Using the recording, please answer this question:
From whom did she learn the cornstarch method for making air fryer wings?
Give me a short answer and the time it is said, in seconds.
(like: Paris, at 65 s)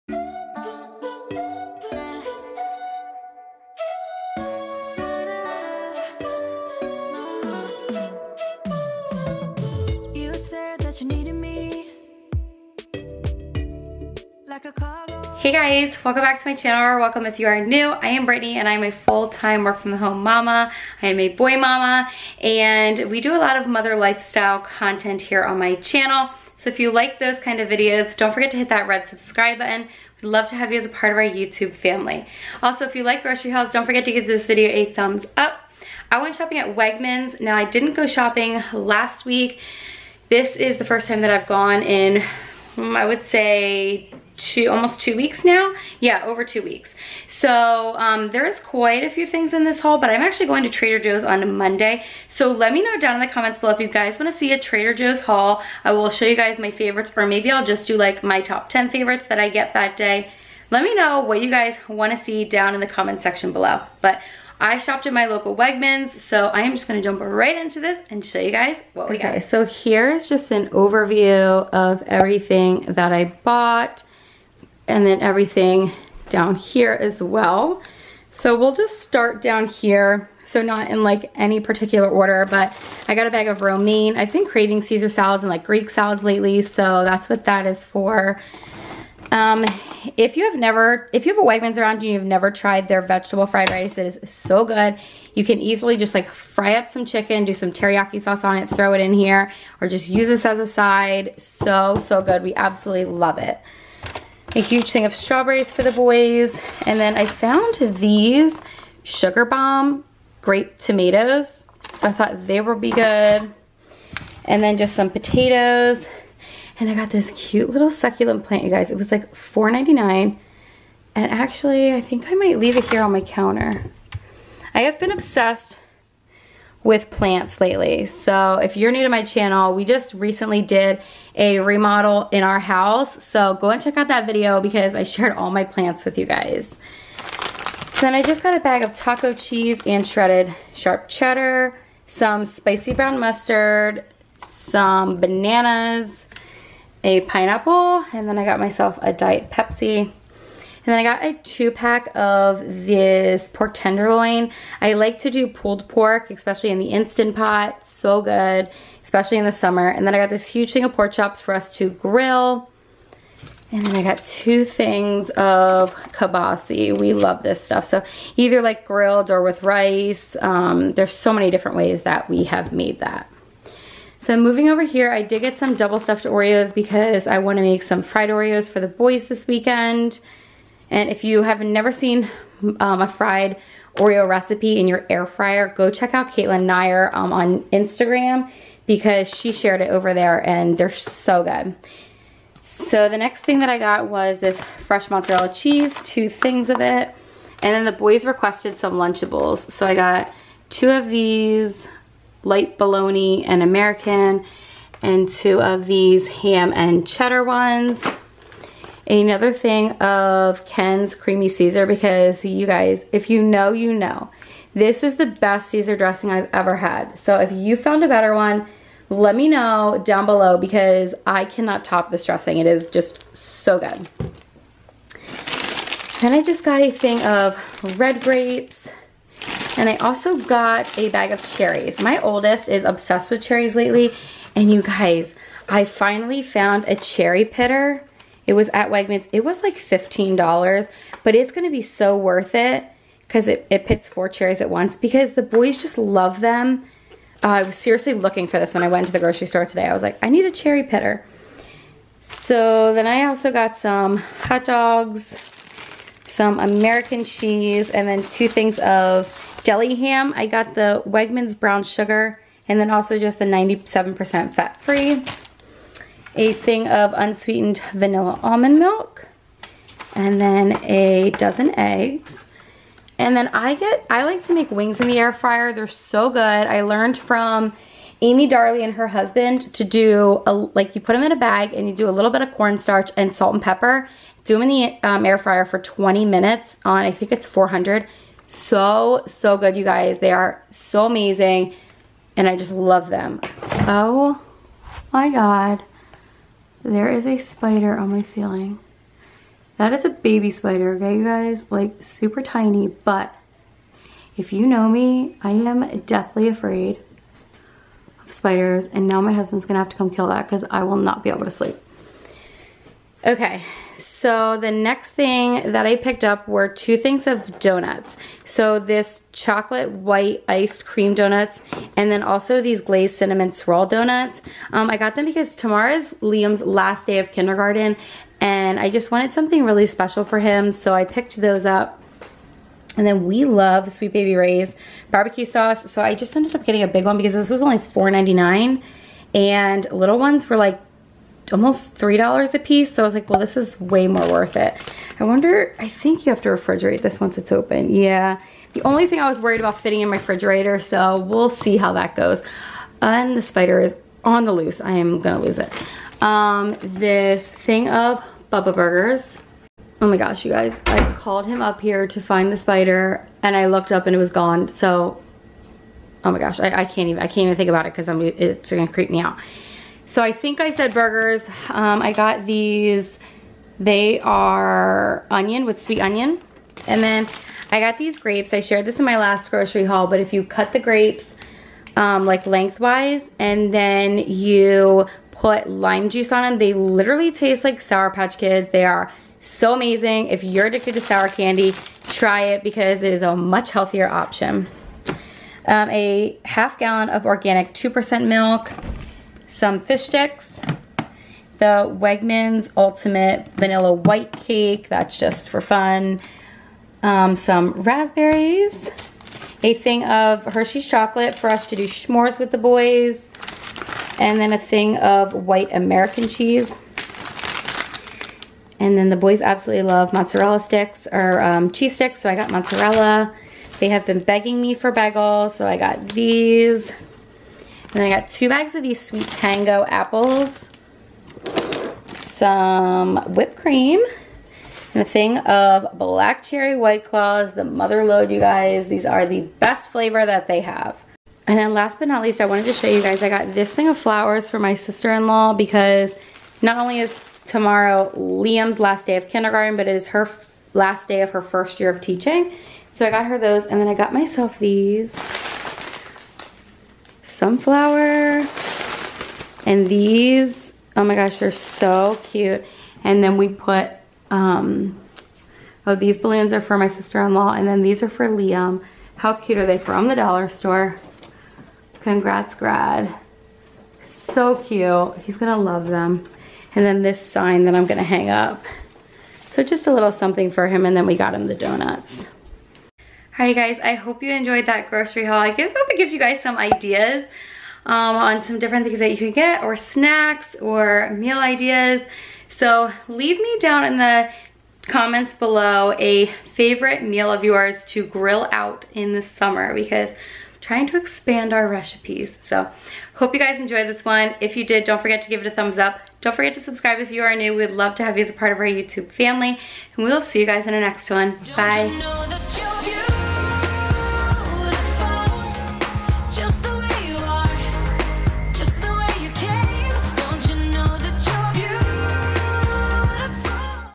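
Amy Darley and her husband, at 278 s.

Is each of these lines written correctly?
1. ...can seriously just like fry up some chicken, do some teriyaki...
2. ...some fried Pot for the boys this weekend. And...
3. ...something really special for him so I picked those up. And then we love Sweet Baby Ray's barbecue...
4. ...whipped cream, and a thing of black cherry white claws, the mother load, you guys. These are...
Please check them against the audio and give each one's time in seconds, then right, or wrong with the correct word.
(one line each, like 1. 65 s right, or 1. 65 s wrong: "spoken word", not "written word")
1. 95 s wrong: "easily", not "seriously"
2. 177 s wrong: "Oreos", not "Pot"
3. 329 s right
4. 433 s right.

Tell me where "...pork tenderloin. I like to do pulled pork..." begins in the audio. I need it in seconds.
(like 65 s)
153 s.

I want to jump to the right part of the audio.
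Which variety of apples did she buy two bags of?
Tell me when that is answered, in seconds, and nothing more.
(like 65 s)
429 s.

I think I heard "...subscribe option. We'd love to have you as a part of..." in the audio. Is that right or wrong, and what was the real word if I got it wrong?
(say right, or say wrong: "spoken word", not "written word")
wrong: "button", not "option".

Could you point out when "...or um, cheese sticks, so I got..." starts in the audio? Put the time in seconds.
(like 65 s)
421 s.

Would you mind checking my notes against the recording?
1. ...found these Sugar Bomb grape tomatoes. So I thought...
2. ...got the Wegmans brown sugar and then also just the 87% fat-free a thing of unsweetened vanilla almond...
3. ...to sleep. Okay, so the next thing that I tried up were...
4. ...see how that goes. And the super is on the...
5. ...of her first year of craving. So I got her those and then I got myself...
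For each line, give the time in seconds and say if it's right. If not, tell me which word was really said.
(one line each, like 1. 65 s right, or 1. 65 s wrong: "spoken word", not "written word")
1. 107 s right
2. 260 s wrong: "97", not "87"
3. 311 s wrong: "picked", not "tried"
4. 351 s wrong: "spider", not "super"
5. 451 s wrong: "teaching", not "craving".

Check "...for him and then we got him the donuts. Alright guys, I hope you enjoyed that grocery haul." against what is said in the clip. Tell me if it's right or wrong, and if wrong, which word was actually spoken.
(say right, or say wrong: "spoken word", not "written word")
right.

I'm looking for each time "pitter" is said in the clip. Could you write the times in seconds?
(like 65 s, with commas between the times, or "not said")
237 s, 250 s.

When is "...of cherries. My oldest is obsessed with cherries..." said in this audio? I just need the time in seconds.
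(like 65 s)
231 s.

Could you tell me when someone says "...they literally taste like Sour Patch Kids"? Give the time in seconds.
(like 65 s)
386 s.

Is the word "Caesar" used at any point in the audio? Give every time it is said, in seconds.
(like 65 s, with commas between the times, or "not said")
84 s, 211 s, 215 s.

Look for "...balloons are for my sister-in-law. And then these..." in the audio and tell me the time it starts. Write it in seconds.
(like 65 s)
466 s.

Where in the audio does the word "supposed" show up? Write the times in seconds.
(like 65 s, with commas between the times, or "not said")
not said.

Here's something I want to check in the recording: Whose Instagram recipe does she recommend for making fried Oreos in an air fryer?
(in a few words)
Caitlin Nyer.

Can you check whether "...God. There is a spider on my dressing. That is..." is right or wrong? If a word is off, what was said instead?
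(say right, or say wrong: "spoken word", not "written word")
wrong: "ceiling", not "dressing".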